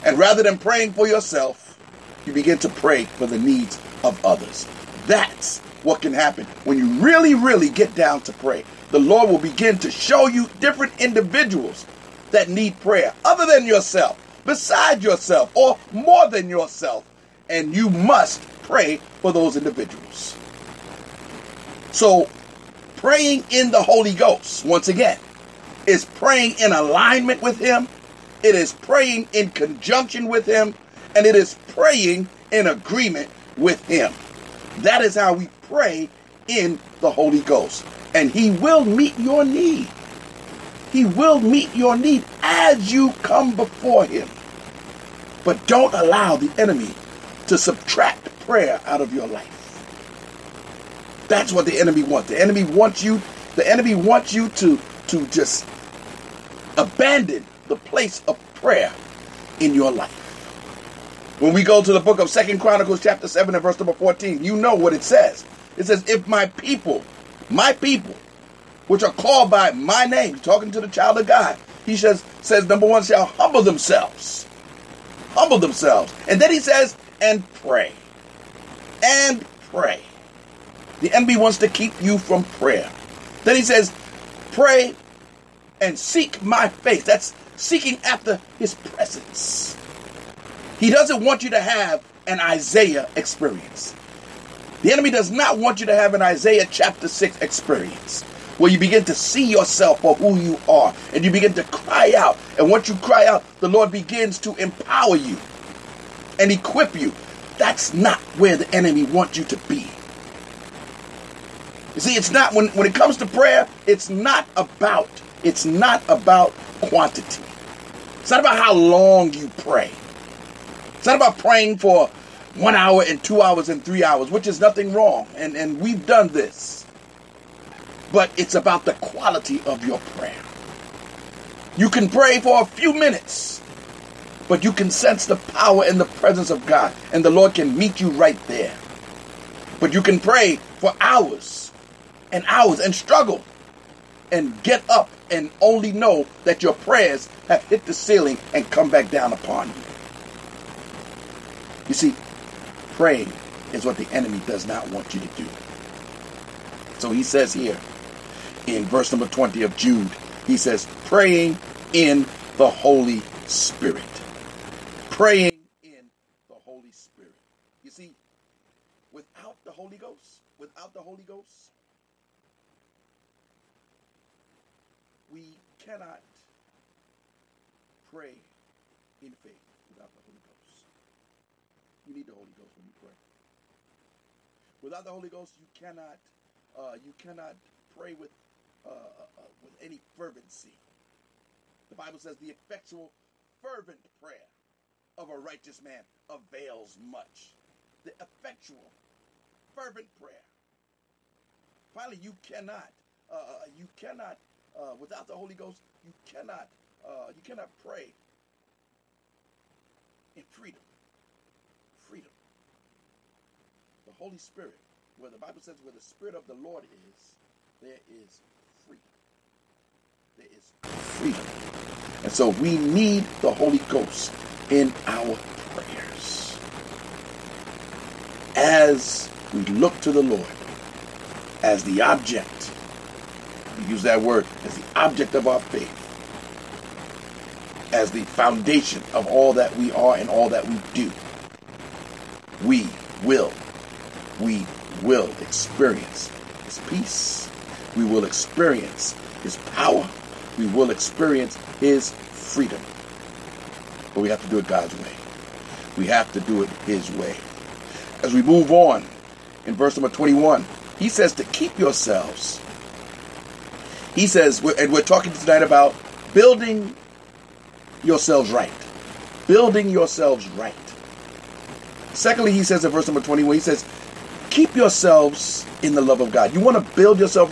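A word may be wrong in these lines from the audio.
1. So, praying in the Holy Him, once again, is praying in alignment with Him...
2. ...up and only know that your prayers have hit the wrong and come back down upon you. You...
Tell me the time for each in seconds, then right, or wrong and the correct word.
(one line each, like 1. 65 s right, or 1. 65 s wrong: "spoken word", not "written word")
1. 21 s wrong: "Ghost", not "Him"
2. 144 s wrong: "ceiling", not "wrong".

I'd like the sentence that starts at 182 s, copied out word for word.
You need the Holy Ghost when you pray.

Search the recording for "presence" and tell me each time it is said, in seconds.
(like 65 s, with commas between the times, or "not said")
88 s, 136 s.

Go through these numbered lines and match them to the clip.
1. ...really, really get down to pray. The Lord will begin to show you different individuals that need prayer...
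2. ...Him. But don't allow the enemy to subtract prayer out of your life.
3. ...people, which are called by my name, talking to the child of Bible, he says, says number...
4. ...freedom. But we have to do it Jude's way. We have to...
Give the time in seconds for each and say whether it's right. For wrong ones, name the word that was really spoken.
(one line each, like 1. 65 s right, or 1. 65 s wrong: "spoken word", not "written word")
1. 7 s right
2. 44 s right
3. 67 s wrong: "God", not "Bible"
4. 252 s wrong: "God", not "Jude".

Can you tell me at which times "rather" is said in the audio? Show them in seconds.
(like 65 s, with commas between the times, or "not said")
0 s.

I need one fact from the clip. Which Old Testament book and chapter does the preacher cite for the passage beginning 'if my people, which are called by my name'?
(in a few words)
Second Chronicles 7.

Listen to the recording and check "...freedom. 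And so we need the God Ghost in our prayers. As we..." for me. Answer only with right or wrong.
wrong.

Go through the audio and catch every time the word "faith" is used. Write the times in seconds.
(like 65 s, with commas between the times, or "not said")
179 s, 235 s.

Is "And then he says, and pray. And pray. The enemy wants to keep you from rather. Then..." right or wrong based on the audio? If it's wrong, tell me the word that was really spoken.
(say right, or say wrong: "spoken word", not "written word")
wrong: "prayer", not "rather".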